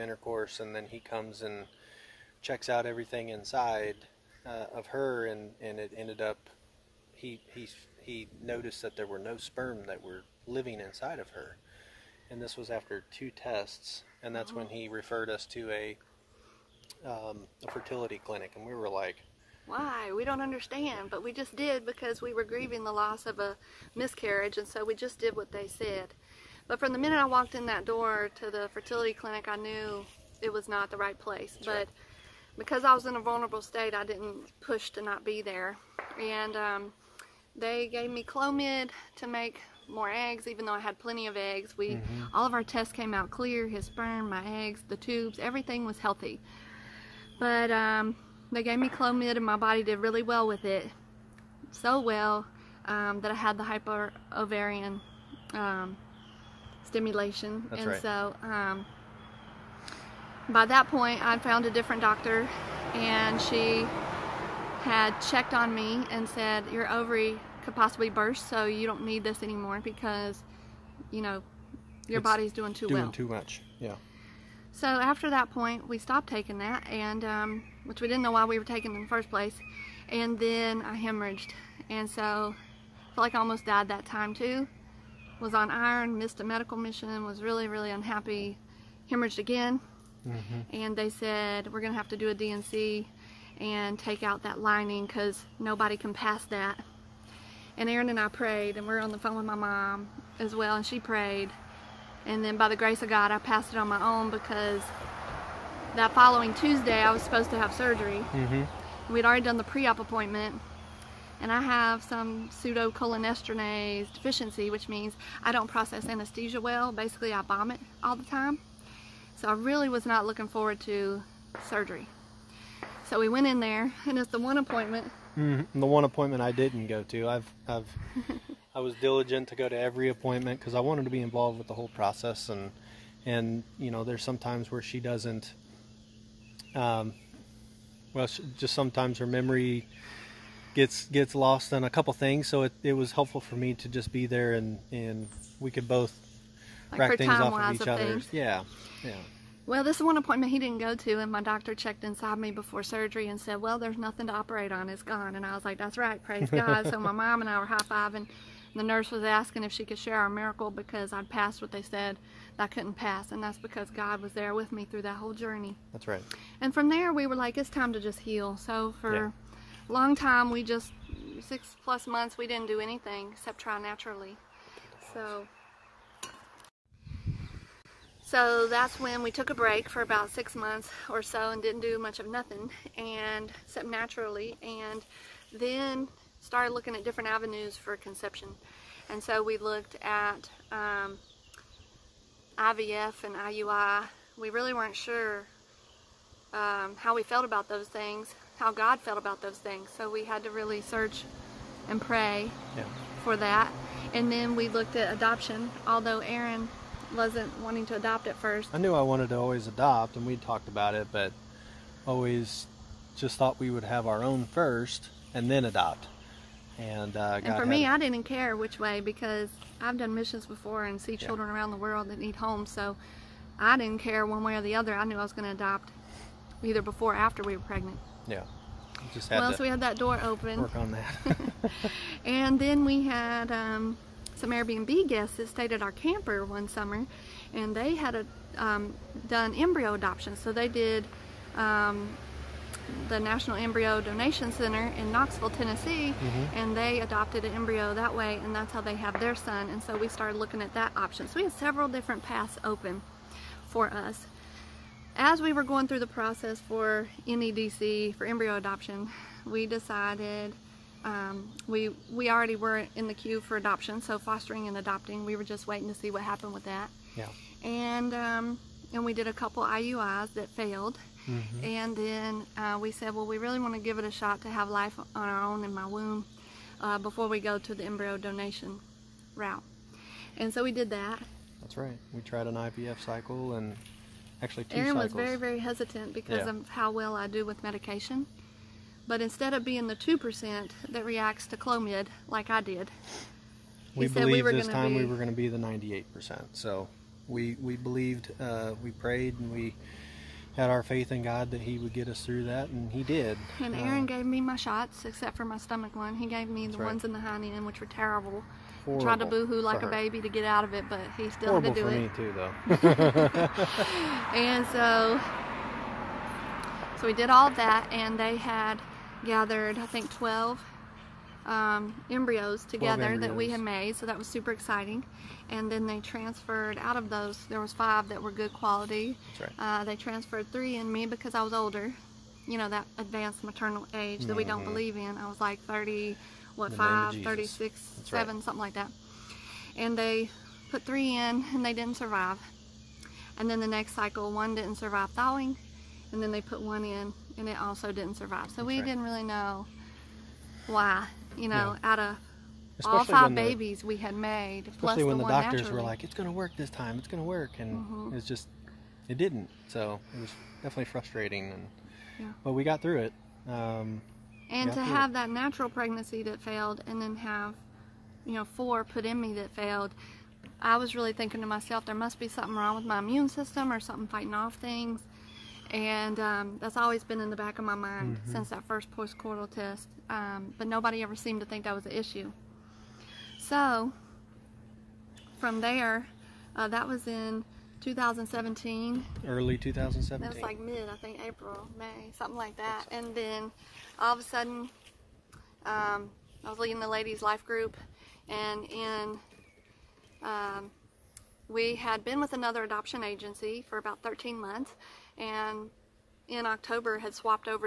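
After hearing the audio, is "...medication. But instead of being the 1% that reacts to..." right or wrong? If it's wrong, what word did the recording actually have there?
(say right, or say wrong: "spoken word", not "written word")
wrong: "2", not "1".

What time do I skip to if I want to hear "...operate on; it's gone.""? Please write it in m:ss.
2:34.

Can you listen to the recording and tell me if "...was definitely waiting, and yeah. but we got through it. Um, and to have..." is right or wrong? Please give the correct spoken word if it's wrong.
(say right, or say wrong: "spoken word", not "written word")
wrong: "frustrating", not "waiting".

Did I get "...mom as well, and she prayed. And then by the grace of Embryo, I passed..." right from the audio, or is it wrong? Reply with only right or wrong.
wrong.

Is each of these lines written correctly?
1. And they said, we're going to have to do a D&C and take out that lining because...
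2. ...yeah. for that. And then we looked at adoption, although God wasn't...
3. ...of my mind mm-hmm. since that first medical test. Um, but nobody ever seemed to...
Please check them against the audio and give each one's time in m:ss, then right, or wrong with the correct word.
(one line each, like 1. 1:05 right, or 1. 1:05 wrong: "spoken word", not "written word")
1. 1:30 right
2. 3:22 wrong: "Aaron", not "God"
3. 6:17 wrong: "postcoital", not "medical".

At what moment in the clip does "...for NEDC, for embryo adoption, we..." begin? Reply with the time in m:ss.
4:16.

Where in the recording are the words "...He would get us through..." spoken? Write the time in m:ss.
5:01.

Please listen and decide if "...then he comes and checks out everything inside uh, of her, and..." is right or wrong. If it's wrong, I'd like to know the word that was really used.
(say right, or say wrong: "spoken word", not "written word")
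right.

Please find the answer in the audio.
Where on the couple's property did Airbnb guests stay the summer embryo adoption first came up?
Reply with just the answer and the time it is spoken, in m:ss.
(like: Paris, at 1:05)
camper, at 3:55.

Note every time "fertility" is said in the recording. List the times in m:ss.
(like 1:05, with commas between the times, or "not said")
0:17, 0:28.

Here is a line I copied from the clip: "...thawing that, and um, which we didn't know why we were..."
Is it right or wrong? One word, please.
wrong.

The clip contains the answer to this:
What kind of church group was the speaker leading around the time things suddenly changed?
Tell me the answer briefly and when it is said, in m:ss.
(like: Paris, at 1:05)
ladies' life group, at 6:36.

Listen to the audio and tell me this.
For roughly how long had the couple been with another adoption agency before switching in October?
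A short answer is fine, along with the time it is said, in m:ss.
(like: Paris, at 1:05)
13 months, at 6:44.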